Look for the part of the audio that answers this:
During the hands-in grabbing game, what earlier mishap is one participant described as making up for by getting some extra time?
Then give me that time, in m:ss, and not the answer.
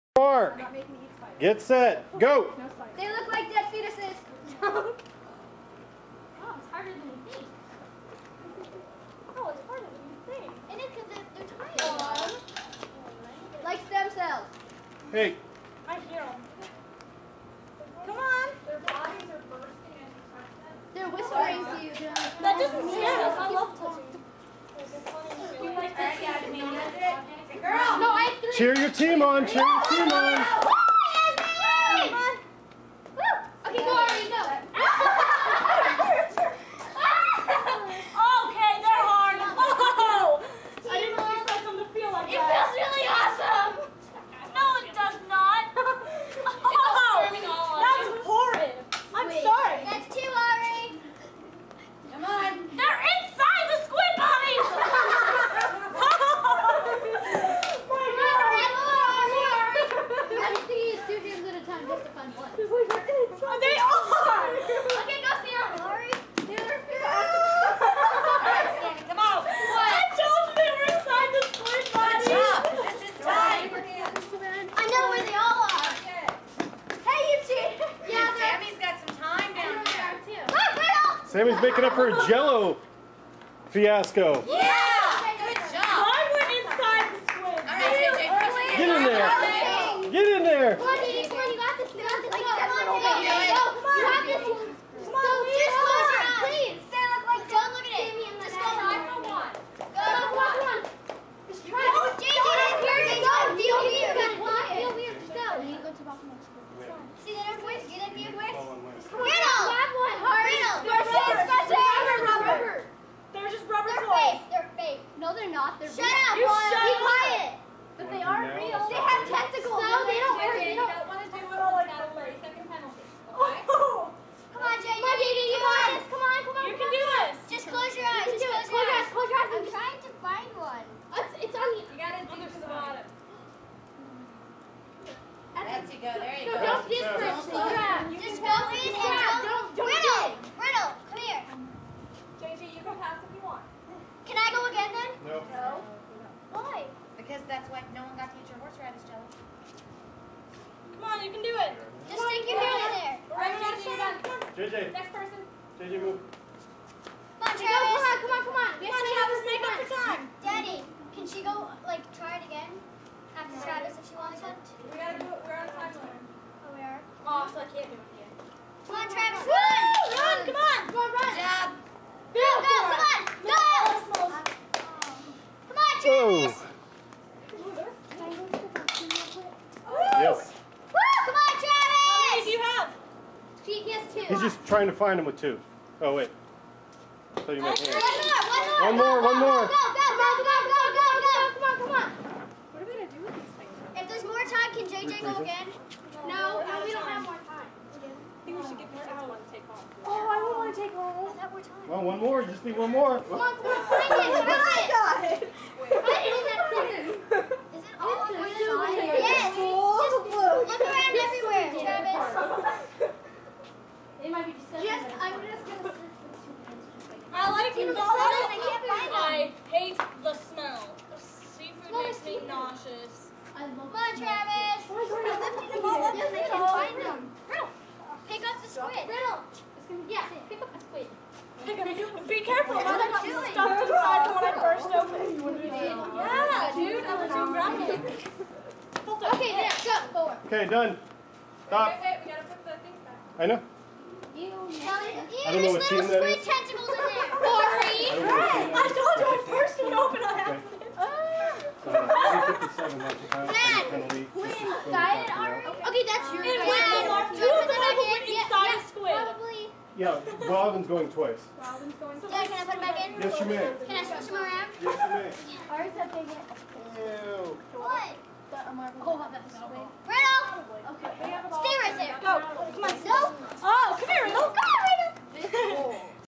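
1:22.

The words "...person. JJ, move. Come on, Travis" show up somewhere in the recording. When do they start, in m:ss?
2:35.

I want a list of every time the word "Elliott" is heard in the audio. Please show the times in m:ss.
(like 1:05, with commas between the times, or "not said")
not said.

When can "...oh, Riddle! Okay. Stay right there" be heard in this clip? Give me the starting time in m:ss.
4:29.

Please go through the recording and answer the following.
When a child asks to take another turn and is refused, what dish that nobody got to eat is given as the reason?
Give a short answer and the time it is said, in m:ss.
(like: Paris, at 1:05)
horseradish jelly, at 2:28.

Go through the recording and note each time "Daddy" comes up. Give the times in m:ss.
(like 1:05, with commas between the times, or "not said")
2:40.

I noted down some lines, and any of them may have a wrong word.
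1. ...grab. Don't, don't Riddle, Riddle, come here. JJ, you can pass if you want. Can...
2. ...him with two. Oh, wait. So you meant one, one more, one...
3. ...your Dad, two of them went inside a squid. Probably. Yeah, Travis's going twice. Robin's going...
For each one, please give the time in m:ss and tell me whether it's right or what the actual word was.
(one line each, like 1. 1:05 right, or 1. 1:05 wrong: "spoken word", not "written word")
1. 2:18 right
2. 3:05 right
3. 4:16 wrong: "Robin", not "Travis".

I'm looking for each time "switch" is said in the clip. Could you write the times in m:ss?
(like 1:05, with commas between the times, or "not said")
4:24.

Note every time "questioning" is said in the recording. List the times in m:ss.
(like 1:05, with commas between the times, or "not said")
not said.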